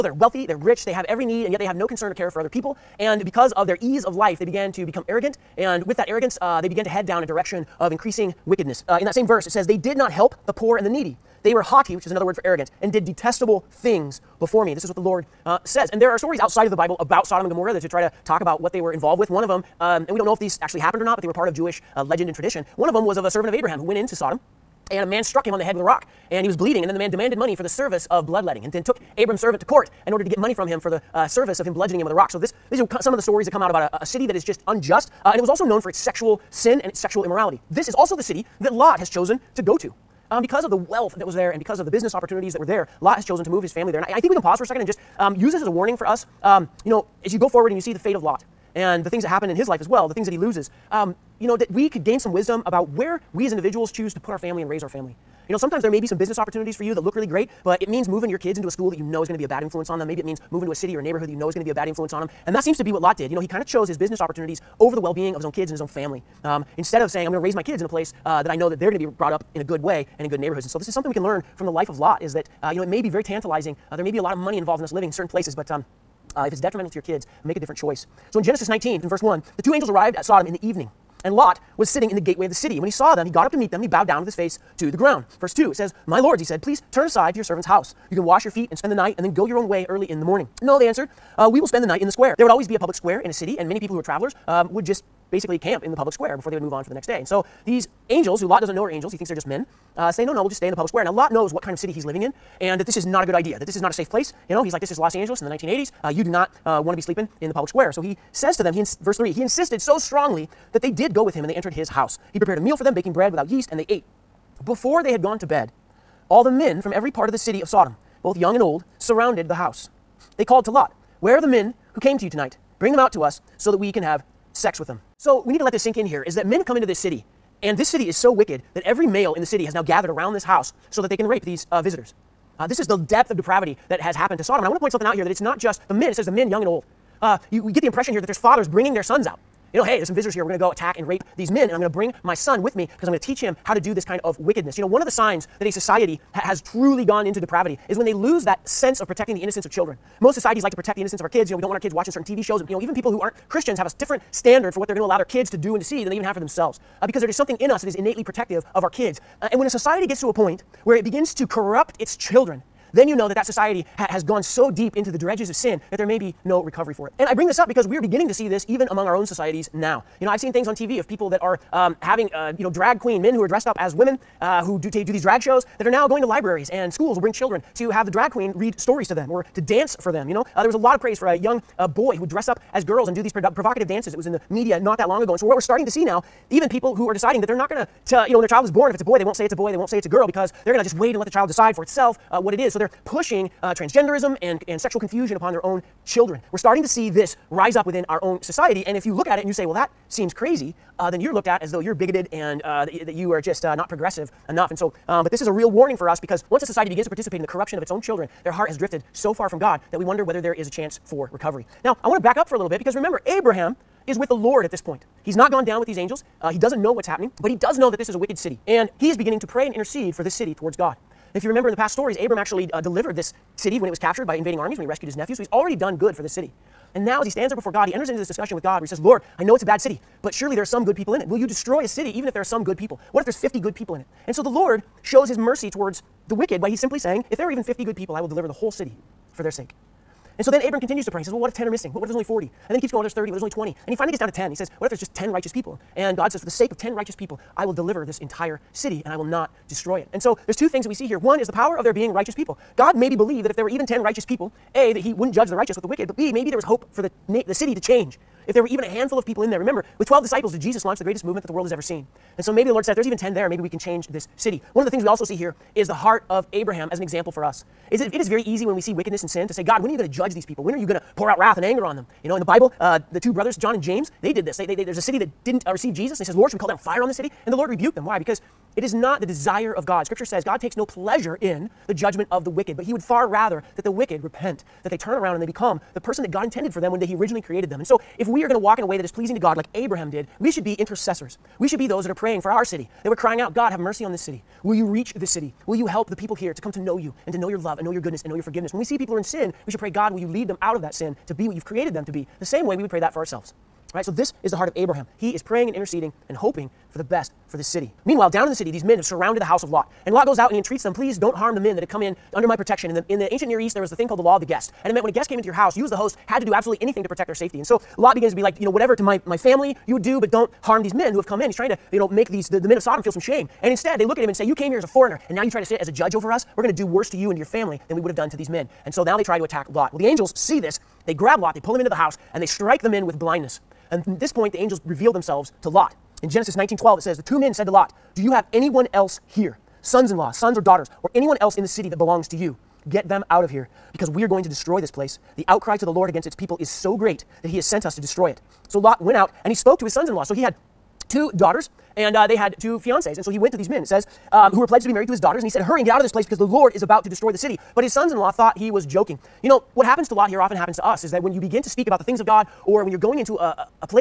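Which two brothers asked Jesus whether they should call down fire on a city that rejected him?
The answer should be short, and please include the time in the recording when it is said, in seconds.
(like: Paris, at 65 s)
John and James, at 273 s.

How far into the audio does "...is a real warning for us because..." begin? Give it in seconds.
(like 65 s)
205 s.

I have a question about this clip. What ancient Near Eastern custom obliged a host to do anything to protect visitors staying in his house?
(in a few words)
the law of the guest.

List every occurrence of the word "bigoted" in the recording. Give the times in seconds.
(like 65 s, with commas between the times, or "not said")
201 s.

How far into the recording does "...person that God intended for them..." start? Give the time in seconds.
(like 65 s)
285 s.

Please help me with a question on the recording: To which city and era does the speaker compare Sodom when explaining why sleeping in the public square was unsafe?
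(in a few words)
Los Angeles in the 1980s.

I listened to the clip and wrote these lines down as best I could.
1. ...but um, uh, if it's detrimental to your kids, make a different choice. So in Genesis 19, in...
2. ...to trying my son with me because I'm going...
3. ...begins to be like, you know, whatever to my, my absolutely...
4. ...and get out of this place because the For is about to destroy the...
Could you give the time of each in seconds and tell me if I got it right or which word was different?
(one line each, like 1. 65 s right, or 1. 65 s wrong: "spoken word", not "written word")
1. 75 s right
2. 141 s wrong: "bring", not "trying"
3. 318 s wrong: "family", not "absolutely"
4. 355 s wrong: "Lord", not "For".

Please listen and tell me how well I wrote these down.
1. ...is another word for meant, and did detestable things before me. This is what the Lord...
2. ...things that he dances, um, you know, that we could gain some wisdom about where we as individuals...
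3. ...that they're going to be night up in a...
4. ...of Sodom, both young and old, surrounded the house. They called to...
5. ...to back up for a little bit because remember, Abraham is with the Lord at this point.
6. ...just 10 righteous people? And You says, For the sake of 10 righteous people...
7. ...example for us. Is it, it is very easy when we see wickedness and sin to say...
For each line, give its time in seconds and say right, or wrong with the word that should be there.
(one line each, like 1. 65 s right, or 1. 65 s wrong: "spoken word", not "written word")
1. 12 s wrong: "arrogant", not "meant"
2. 50 s wrong: "loses", not "dances"
3. 68 s wrong: "brought", not "night"
4. 117 s right
5. 212 s right
6. 244 s wrong: "God", not "You"
7. 267 s right.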